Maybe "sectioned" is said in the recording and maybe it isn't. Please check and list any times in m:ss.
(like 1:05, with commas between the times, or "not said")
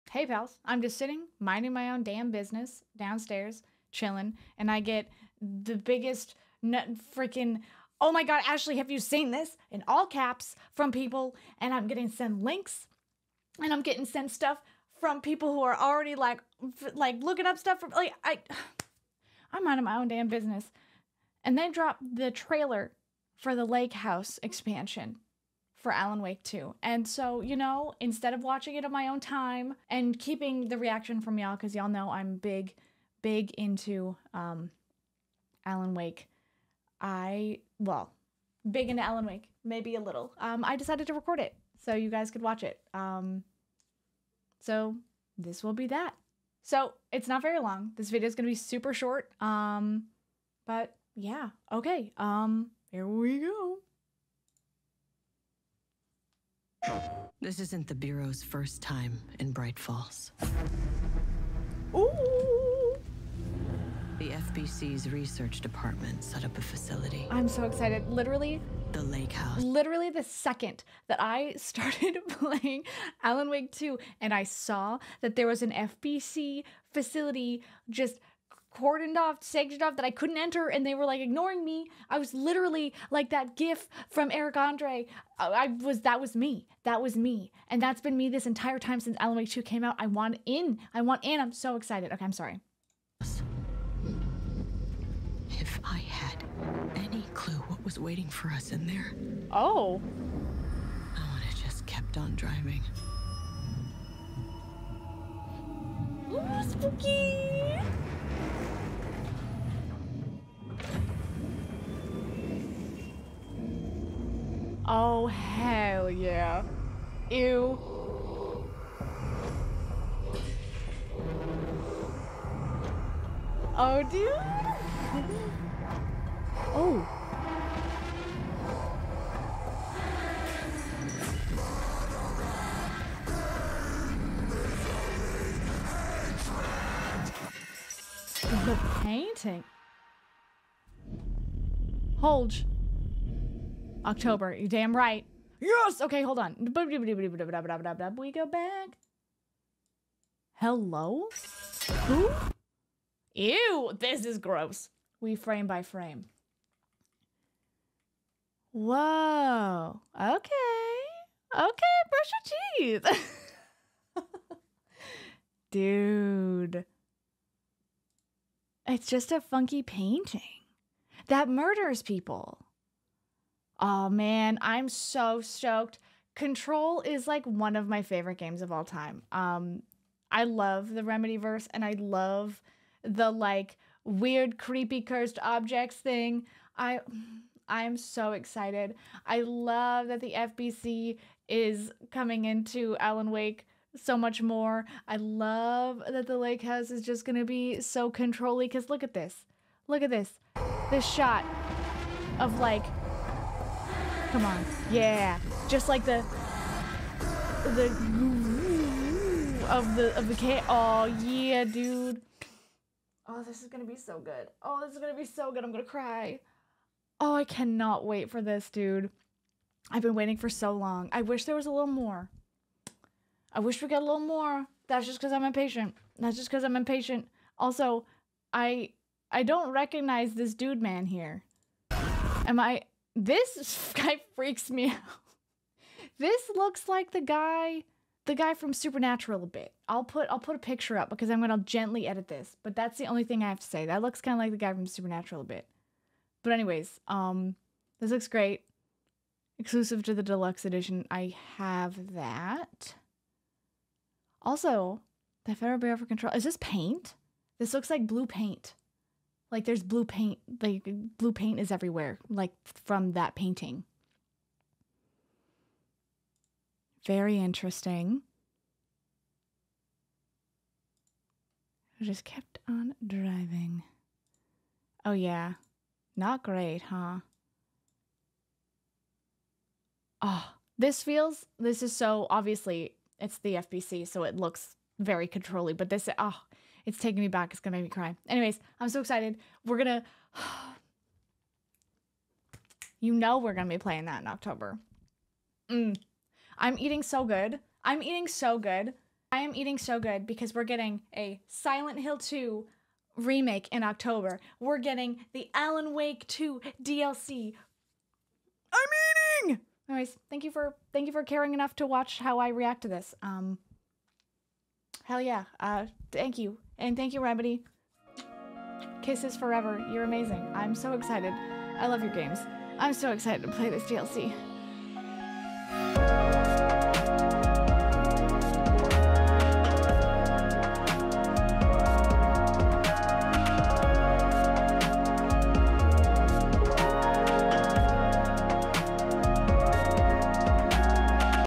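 1:19.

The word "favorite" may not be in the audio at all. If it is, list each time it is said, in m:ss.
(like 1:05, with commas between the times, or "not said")
2:58.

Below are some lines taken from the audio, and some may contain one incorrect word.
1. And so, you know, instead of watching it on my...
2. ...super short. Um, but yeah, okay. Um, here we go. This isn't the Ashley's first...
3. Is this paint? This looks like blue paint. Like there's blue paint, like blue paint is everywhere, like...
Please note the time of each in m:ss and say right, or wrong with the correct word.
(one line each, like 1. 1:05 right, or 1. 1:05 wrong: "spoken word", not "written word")
1. 0:26 right
2. 0:48 wrong: "Bureau", not "Ashley"
3. 4:16 right.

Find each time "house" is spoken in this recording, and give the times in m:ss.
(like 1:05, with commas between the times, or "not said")
0:23, 1:09, 3:16.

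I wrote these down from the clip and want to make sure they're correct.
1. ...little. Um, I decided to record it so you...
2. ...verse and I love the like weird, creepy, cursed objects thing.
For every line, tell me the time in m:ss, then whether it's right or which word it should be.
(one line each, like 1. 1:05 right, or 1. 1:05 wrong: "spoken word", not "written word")
1. 0:40 right
2. 3:01 right.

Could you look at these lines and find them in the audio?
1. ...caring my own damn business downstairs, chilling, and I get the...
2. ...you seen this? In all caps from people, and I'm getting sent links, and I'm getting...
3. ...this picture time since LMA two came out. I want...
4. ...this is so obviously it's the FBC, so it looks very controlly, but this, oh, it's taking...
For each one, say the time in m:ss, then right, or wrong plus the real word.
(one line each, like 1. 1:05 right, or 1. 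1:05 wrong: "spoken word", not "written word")
1. 0:01 wrong: "minding", not "caring"
2. 0:08 right
3. 1:28 wrong: "entire", not "picture"
4. 4:41 right.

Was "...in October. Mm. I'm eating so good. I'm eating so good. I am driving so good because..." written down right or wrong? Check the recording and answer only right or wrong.
wrong.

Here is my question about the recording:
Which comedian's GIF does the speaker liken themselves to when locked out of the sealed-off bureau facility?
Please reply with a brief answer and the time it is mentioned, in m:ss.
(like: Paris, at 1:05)
Eric Andre, at 1:24.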